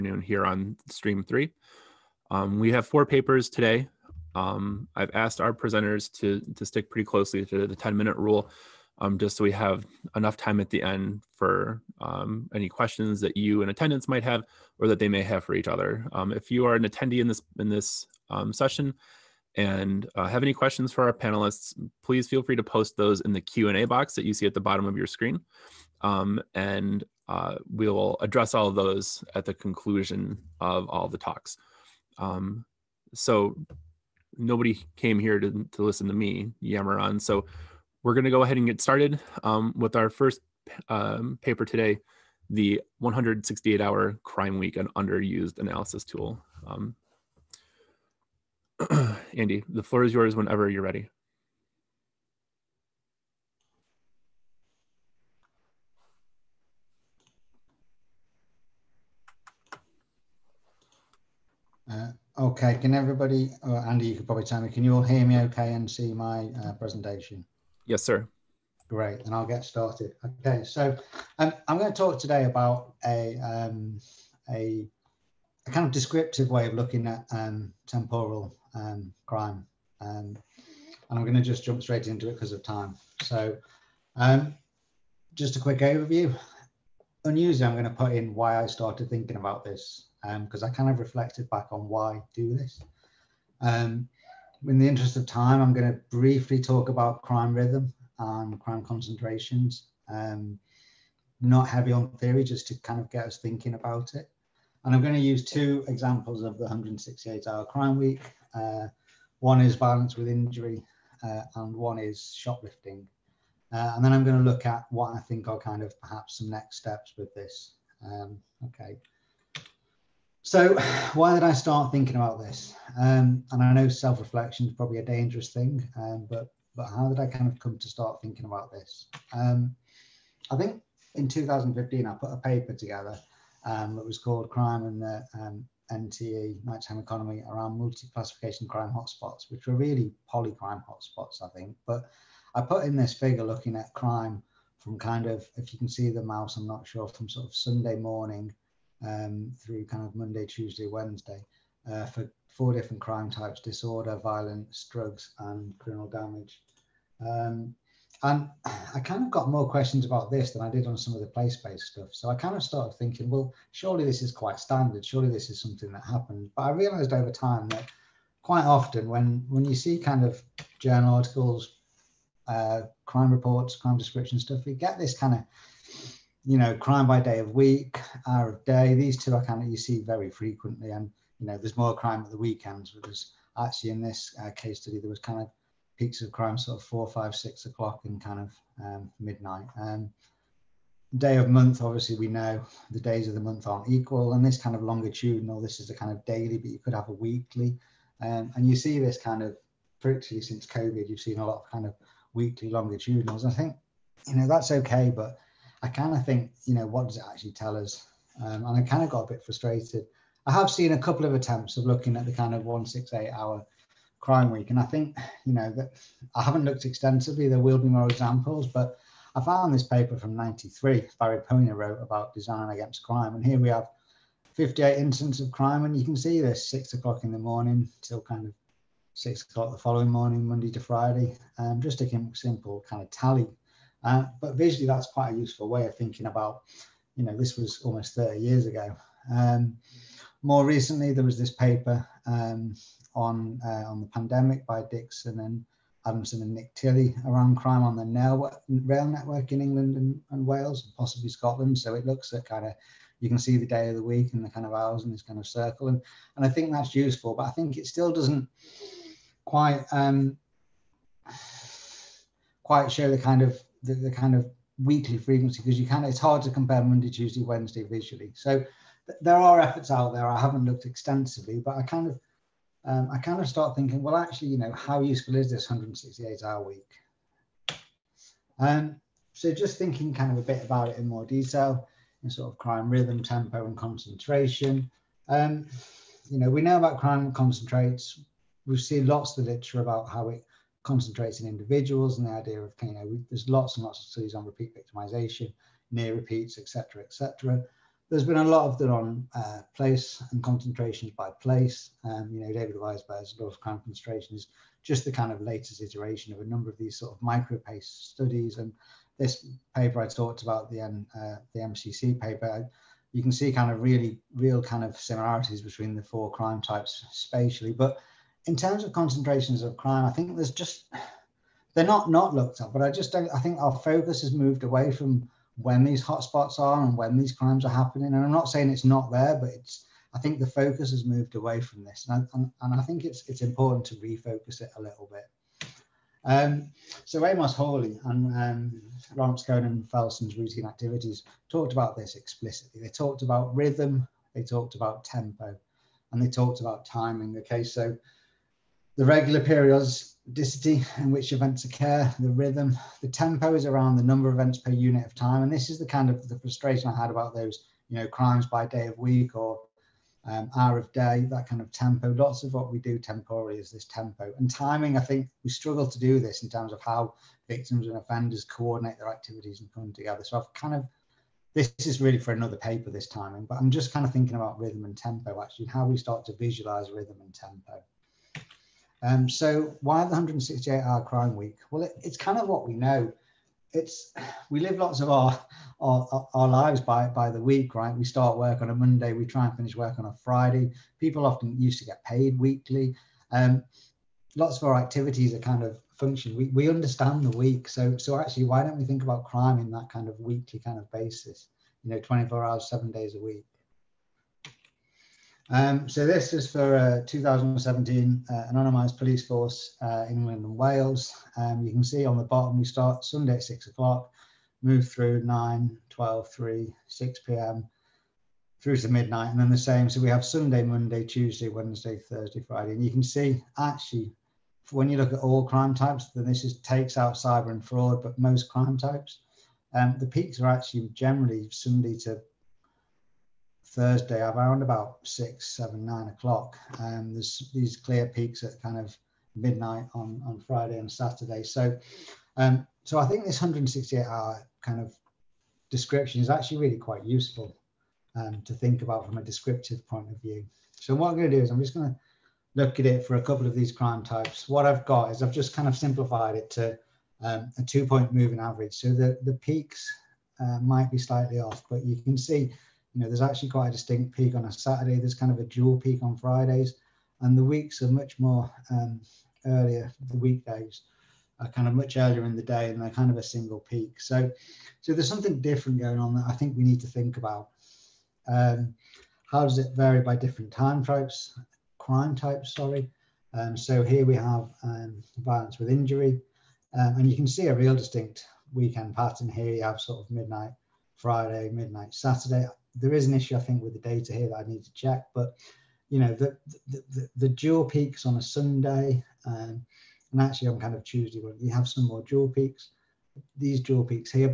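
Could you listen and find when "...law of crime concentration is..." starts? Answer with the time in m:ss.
5:03.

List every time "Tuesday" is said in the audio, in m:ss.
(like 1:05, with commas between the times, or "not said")
2:30, 4:27, 7:01, 8:20.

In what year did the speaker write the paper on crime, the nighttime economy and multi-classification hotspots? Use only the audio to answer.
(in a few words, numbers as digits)
2015.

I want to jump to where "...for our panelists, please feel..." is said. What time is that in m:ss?
0:20.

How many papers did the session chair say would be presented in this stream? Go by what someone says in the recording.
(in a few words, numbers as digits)
4.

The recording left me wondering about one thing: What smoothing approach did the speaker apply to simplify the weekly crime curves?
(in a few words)
two point moving average.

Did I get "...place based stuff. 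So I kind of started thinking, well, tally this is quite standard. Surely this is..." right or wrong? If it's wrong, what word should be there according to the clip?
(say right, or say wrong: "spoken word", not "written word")
wrong: "surely", not "tally".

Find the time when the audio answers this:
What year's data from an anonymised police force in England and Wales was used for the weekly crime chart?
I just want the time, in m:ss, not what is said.
6:47.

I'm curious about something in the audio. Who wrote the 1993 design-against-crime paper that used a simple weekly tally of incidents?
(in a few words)
Barry Poyner.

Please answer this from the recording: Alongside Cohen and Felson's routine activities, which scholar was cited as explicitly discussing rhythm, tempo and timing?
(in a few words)
Amos Hawley.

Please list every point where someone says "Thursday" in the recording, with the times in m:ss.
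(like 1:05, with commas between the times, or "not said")
7:01, 7:13.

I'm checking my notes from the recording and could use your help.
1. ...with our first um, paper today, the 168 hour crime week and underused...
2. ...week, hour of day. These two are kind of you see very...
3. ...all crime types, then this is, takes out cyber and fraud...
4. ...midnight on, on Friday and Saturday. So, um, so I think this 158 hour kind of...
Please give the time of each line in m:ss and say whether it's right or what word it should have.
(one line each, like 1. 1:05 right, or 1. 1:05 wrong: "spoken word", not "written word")
1. 0:39 right
2. 2:57 right
3. 7:05 right
4. 7:19 wrong: "168", not "158".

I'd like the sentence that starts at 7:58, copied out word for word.
Um, how does it vary by different time types, crime types?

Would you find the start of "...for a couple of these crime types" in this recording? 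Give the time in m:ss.
7:33.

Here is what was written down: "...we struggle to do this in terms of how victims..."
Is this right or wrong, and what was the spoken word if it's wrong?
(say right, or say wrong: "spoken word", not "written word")
right.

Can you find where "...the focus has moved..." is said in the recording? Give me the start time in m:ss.
5:30.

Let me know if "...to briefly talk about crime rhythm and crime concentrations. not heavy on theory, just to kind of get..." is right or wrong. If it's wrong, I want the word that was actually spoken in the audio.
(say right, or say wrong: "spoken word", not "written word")
right.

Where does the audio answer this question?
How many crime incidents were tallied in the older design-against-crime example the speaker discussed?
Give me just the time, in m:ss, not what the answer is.
3:44.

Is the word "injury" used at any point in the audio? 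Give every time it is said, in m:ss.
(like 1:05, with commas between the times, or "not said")
1:50, 8:05.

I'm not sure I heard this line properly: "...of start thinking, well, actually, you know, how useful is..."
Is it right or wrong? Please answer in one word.
right.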